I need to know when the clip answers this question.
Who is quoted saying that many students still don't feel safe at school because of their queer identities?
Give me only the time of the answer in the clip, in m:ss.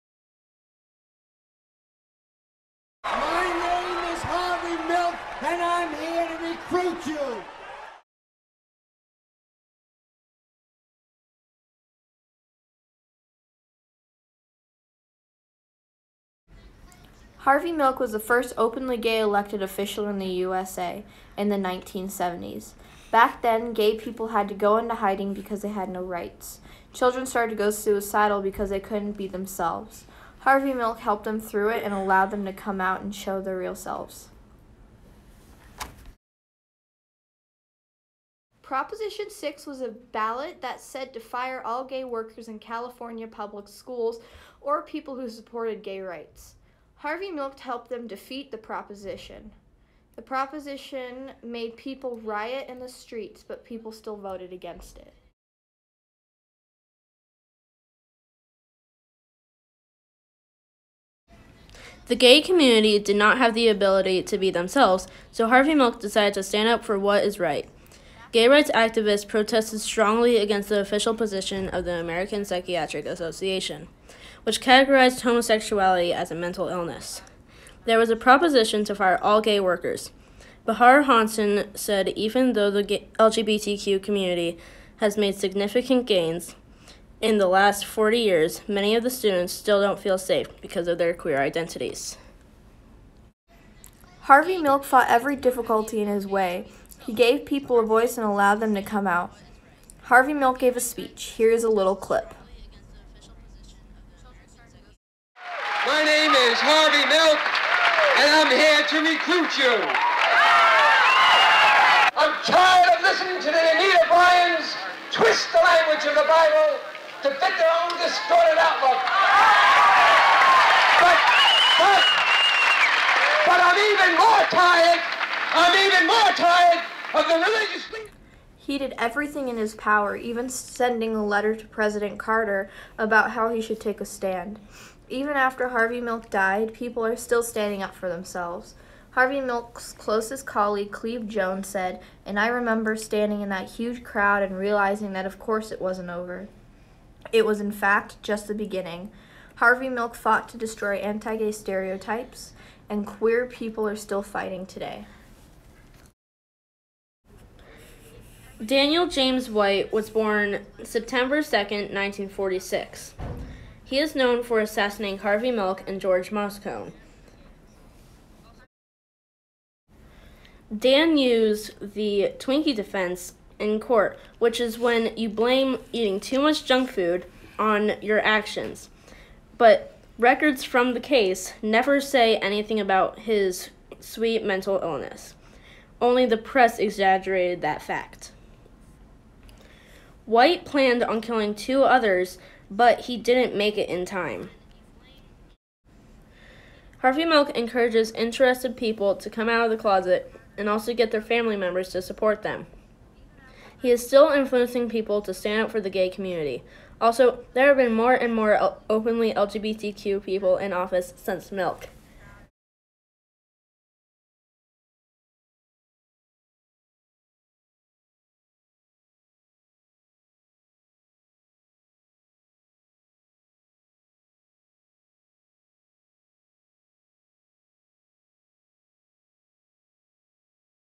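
1:20.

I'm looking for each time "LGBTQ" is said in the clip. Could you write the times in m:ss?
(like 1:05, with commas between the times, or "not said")
1:23, 3:29.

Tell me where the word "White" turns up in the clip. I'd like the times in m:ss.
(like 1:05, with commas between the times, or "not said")
2:39, 3:10.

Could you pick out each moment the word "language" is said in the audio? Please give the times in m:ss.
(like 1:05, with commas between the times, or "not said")
1:55.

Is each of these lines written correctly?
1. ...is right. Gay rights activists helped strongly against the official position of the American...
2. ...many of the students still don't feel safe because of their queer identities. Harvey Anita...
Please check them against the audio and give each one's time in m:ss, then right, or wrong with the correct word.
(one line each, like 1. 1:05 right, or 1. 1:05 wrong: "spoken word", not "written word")
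1. 1:07 wrong: "protested", not "helped"
2. 1:28 wrong: "Milk", not "Anita".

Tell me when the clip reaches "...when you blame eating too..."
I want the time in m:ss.
2:54.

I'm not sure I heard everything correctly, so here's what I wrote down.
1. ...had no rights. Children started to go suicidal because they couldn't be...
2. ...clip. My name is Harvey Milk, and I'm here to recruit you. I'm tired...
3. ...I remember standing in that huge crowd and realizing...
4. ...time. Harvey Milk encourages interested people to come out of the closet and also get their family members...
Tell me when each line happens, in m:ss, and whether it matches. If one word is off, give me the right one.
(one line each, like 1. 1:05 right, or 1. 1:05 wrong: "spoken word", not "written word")
1. 0:25 right
2. 1:41 right
3. 2:22 right
4. 3:14 right.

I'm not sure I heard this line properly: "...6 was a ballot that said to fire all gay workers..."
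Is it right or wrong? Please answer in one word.
right.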